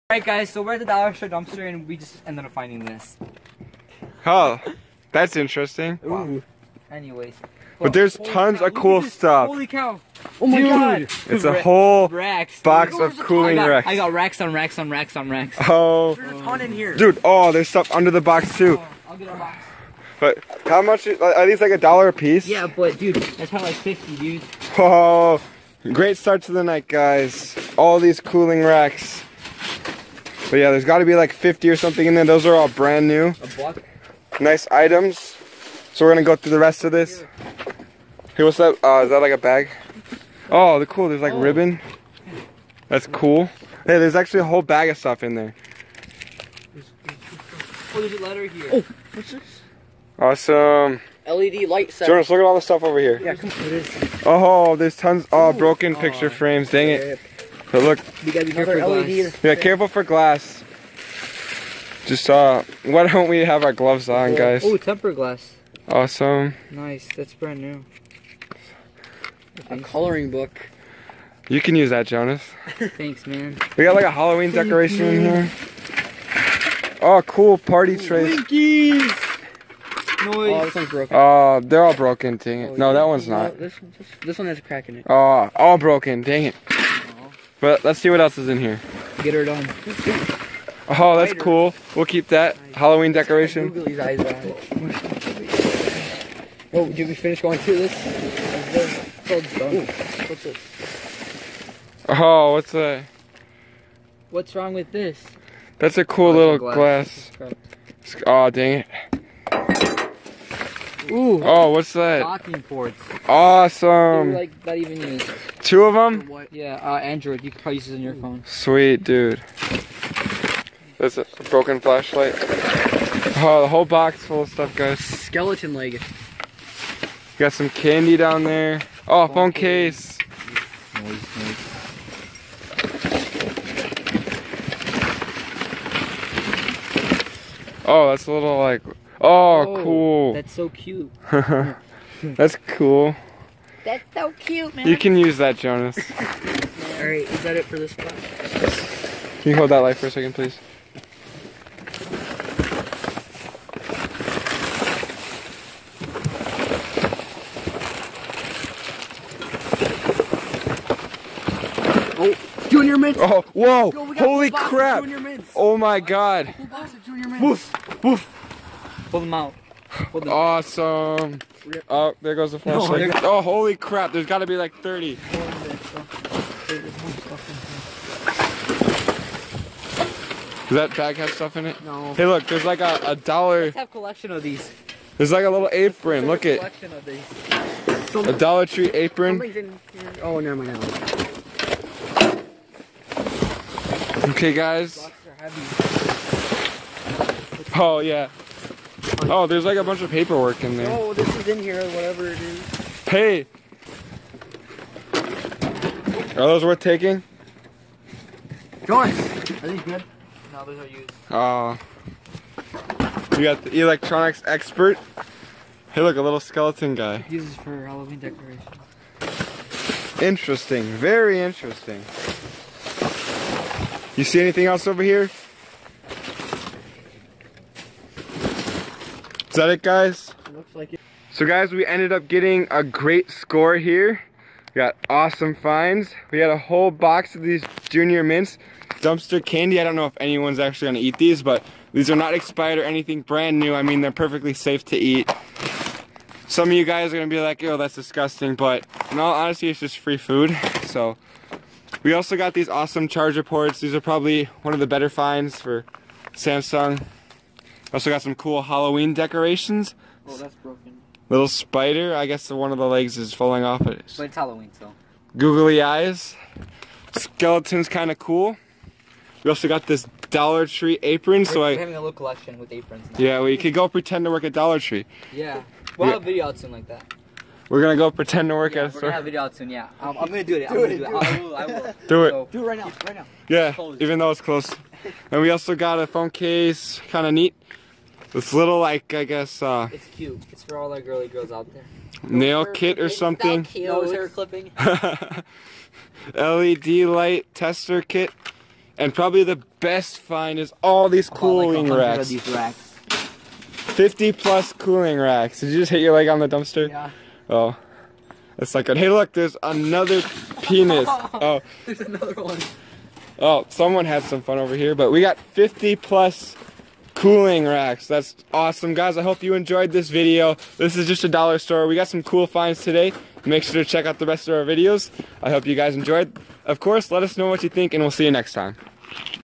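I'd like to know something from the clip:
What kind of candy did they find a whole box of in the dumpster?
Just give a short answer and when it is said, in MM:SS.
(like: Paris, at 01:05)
Junior Mints, at 02:42.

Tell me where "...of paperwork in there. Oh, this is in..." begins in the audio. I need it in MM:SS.
03:20.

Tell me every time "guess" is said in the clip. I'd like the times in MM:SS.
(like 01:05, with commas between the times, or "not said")
04:22, 04:49.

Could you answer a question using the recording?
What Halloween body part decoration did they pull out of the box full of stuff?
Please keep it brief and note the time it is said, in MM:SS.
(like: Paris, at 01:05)
Skeleton leg, at 02:04.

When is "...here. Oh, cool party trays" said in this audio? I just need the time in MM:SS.
01:15.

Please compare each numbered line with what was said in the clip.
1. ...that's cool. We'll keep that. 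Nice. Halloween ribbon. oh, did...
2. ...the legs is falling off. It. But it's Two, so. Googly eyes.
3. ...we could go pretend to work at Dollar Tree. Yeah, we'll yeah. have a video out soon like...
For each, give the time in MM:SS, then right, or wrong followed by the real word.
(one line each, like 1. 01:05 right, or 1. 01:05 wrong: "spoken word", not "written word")
1. 01:31 wrong: "decoration", not "ribbon"
2. 04:22 wrong: "Halloween", not "Two"
3. 04:33 right.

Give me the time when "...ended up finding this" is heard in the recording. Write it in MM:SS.
00:02.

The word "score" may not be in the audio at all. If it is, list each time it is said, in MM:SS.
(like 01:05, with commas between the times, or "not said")
03:53.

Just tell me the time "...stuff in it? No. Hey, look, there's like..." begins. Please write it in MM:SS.
03:01.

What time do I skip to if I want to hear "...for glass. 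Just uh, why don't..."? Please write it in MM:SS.
00:59.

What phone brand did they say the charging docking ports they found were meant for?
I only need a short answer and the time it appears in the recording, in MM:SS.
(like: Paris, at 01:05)
Samsung, at 04:16.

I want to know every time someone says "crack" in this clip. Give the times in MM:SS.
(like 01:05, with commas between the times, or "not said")
01:24.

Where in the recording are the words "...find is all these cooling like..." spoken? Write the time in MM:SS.
05:00.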